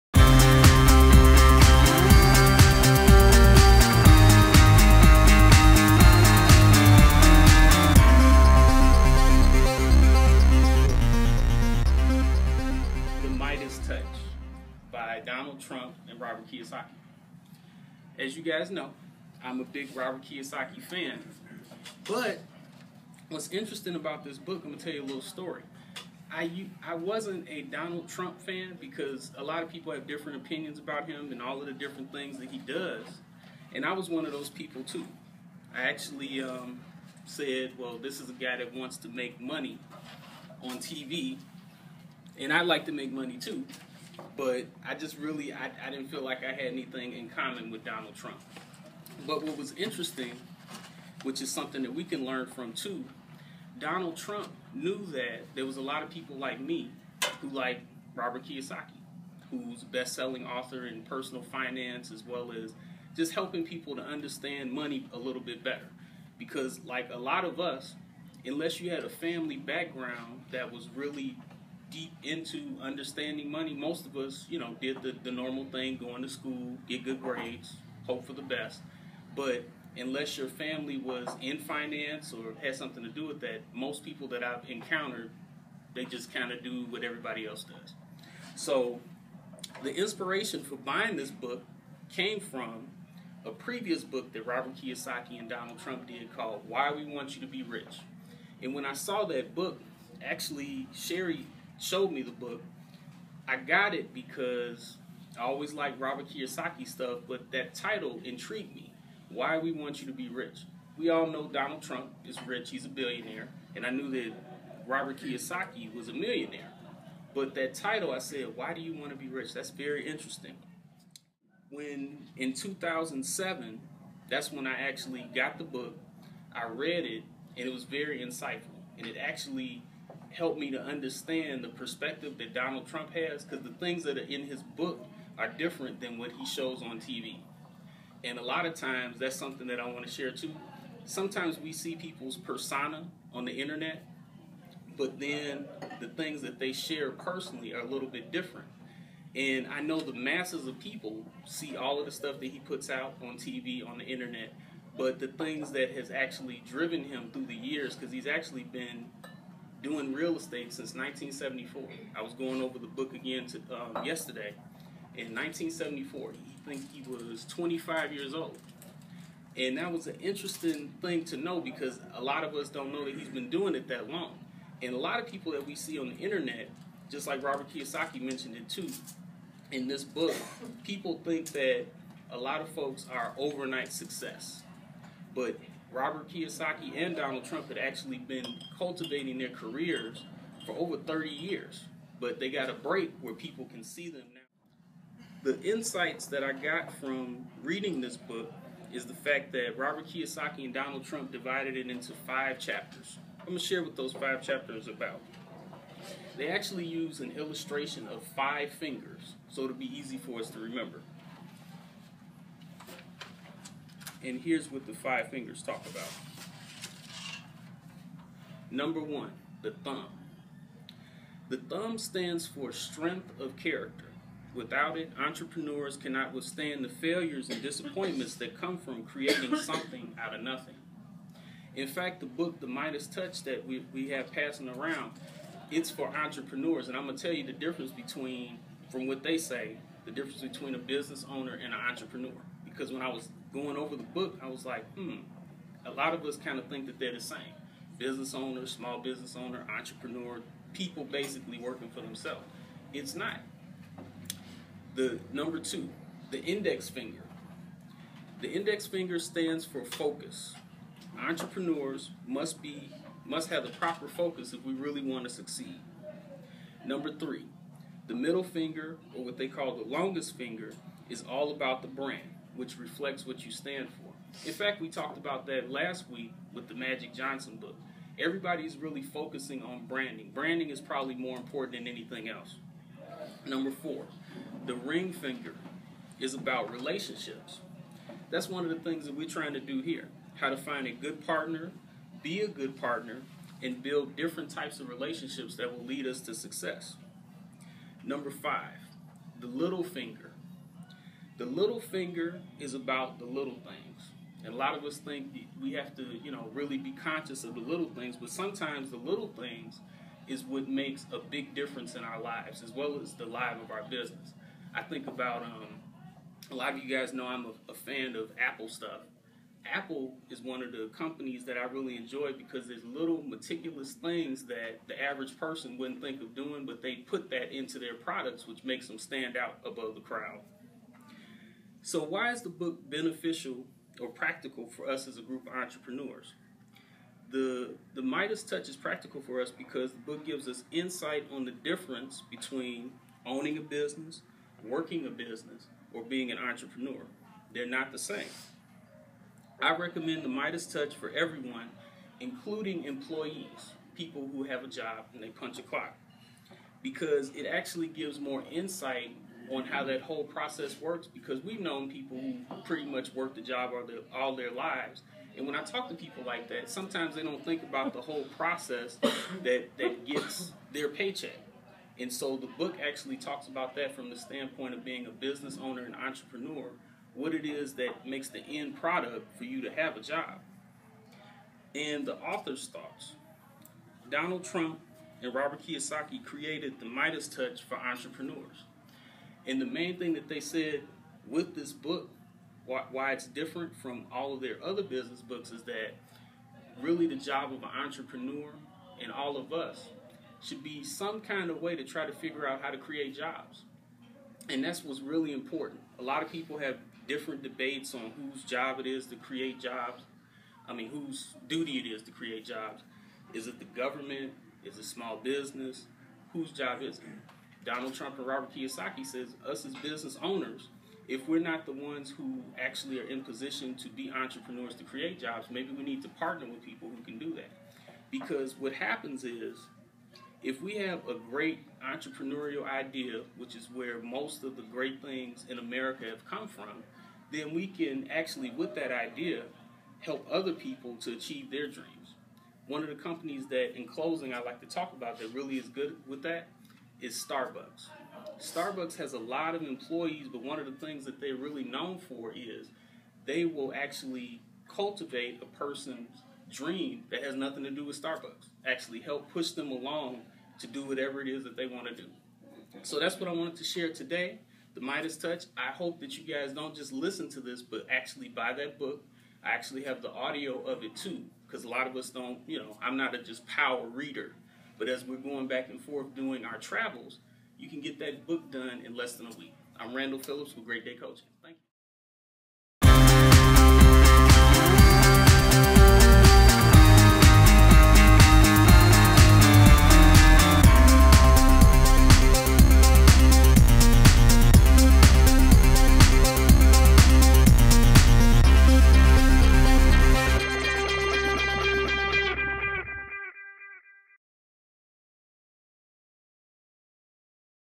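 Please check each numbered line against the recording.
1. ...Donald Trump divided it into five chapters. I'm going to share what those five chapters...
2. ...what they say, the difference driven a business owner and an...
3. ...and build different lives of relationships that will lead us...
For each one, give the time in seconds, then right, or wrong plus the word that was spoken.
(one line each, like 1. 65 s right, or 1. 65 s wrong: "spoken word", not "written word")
1. 200 s right
2. 239 s wrong: "between", not "driven"
3. 293 s wrong: "types", not "lives".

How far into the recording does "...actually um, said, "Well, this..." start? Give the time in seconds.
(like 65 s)
35 s.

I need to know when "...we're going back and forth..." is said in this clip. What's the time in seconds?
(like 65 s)
475 s.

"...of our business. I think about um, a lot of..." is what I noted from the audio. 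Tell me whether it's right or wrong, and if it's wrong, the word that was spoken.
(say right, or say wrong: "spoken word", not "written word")
right.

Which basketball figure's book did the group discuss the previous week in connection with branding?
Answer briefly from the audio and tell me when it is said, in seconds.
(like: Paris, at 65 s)
Magic Johnson, at 276 s.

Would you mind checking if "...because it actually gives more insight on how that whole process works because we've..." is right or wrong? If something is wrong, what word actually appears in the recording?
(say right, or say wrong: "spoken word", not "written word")
right.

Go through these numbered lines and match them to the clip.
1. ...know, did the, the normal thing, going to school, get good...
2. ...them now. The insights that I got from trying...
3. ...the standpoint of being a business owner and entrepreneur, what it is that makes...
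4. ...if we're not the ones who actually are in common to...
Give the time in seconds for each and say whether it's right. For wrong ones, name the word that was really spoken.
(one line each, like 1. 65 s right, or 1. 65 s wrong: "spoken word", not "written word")
1. 74 s right
2. 194 s wrong: "reading", not "trying"
3. 374 s right
4. 421 s wrong: "position", not "common".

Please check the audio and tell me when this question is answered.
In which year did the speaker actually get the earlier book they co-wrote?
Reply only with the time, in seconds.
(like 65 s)
122 s.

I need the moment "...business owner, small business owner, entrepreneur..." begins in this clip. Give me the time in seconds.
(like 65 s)
247 s.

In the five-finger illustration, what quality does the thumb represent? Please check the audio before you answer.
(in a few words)
Strength of character.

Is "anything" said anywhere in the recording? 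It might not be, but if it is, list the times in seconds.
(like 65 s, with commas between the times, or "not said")
46 s, 281 s.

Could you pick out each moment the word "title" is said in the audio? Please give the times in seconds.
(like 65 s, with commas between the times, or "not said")
107 s, 117 s.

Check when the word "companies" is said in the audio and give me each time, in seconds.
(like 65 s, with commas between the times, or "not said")
320 s, 442 s.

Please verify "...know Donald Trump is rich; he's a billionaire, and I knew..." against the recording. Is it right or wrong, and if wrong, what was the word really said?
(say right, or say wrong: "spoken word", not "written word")
right.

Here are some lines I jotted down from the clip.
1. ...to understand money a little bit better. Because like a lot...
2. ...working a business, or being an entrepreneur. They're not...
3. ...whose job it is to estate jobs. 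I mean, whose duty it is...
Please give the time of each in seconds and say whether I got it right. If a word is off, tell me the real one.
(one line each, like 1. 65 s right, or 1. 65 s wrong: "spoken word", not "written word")
1. 63 s right
2. 344 s right
3. 408 s wrong: "create", not "estate".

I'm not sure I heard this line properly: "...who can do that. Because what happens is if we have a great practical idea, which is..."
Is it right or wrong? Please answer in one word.
wrong.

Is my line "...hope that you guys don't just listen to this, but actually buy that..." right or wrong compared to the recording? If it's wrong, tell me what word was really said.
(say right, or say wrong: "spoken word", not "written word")
right.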